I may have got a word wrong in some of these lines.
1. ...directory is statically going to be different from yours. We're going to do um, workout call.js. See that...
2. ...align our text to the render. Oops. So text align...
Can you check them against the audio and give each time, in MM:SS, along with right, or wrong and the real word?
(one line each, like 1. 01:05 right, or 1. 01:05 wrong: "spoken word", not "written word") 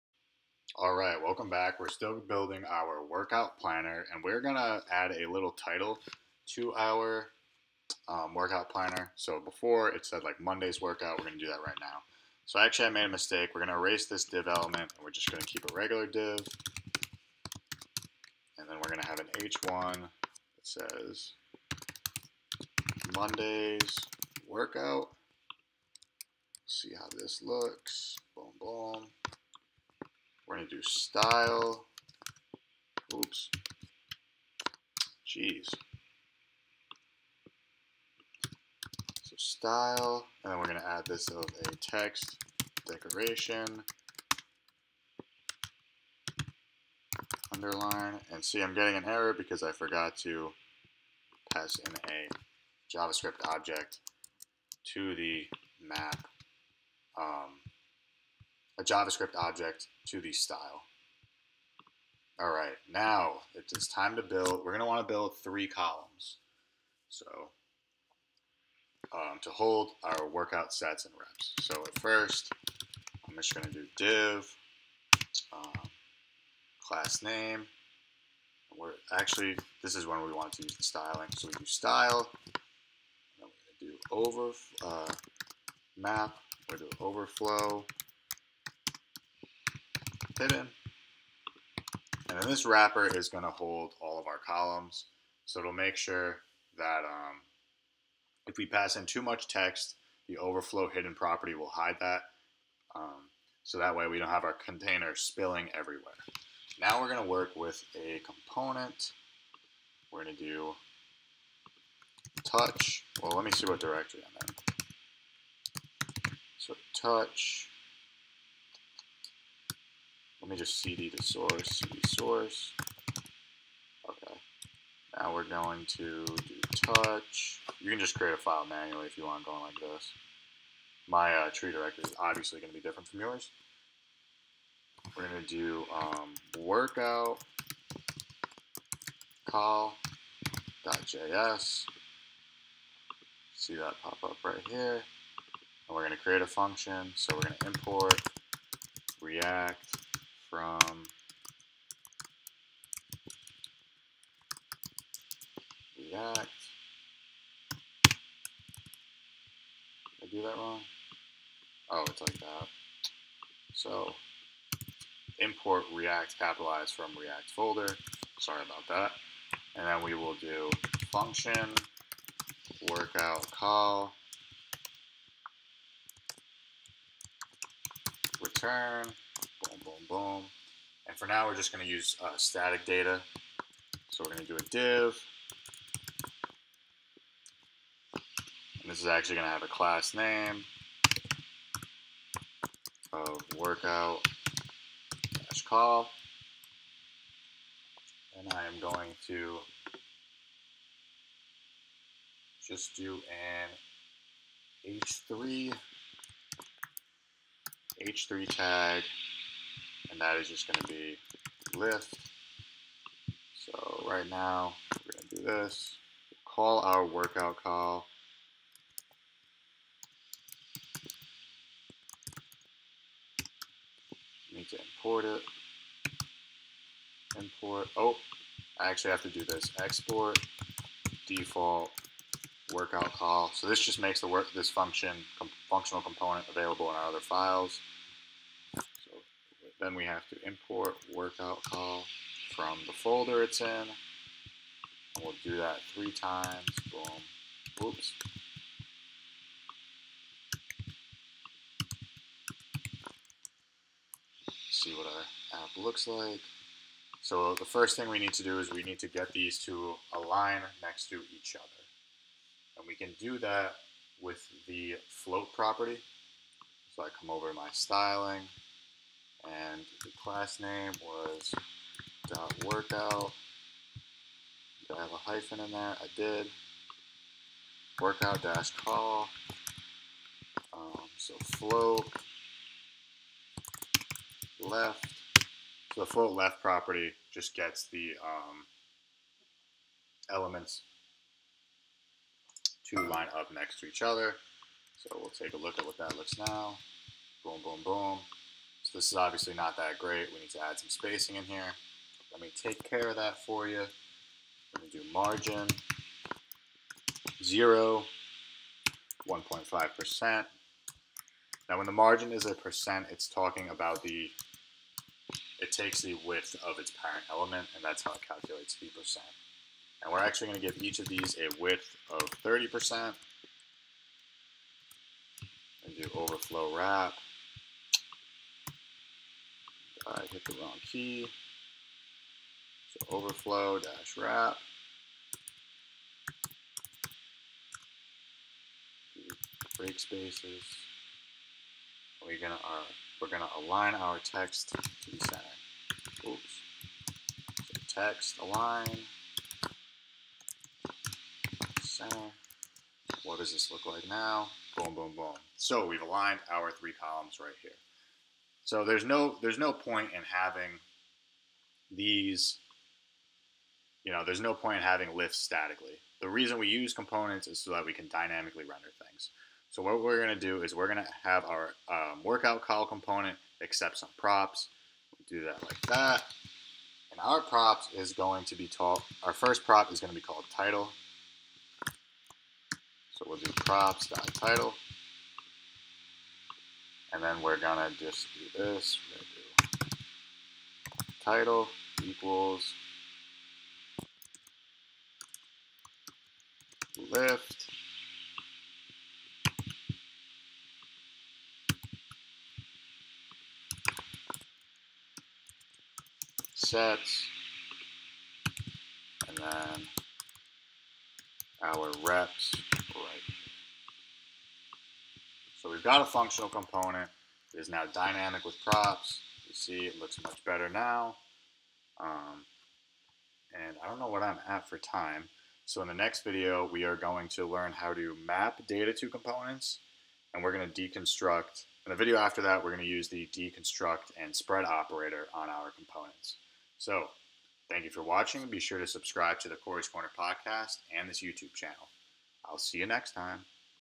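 1. 02:11 wrong: "obviously", not "statically"
2. 05:43 wrong: "center", not "render".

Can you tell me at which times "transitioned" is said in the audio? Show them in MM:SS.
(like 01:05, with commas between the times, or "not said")
not said.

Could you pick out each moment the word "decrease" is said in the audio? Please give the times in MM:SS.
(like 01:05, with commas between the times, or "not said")
not said.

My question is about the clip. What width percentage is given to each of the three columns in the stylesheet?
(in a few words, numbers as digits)
30%.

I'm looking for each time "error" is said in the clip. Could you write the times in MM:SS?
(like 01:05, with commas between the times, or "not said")
00:49.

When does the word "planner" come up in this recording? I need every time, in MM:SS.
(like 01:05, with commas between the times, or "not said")
00:03, 00:08.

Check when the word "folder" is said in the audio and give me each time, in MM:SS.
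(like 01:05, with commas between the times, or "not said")
02:47, 04:02.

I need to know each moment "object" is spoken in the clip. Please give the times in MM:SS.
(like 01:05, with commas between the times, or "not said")
00:53, 00:59.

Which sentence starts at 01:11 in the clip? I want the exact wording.
So at first, I'm just going to do div, um, class name.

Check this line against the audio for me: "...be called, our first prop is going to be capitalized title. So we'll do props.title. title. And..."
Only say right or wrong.
wrong.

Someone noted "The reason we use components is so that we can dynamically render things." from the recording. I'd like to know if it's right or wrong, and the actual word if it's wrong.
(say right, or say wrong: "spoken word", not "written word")
right.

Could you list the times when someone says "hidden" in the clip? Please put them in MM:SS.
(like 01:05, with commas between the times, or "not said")
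01:40.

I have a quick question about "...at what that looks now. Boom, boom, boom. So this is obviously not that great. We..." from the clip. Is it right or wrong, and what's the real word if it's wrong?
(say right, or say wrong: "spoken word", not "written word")
right.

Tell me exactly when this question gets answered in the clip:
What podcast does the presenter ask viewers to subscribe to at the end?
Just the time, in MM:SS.
07:19.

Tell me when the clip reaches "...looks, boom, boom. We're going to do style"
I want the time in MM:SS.
00:27.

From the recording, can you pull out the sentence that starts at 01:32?
And then this wrapper is going to hold all of our columns.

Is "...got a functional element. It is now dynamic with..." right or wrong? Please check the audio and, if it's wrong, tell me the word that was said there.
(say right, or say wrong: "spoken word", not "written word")
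wrong: "component", not "element".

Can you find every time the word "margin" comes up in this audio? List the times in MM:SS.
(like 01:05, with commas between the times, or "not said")
05:05, 05:11.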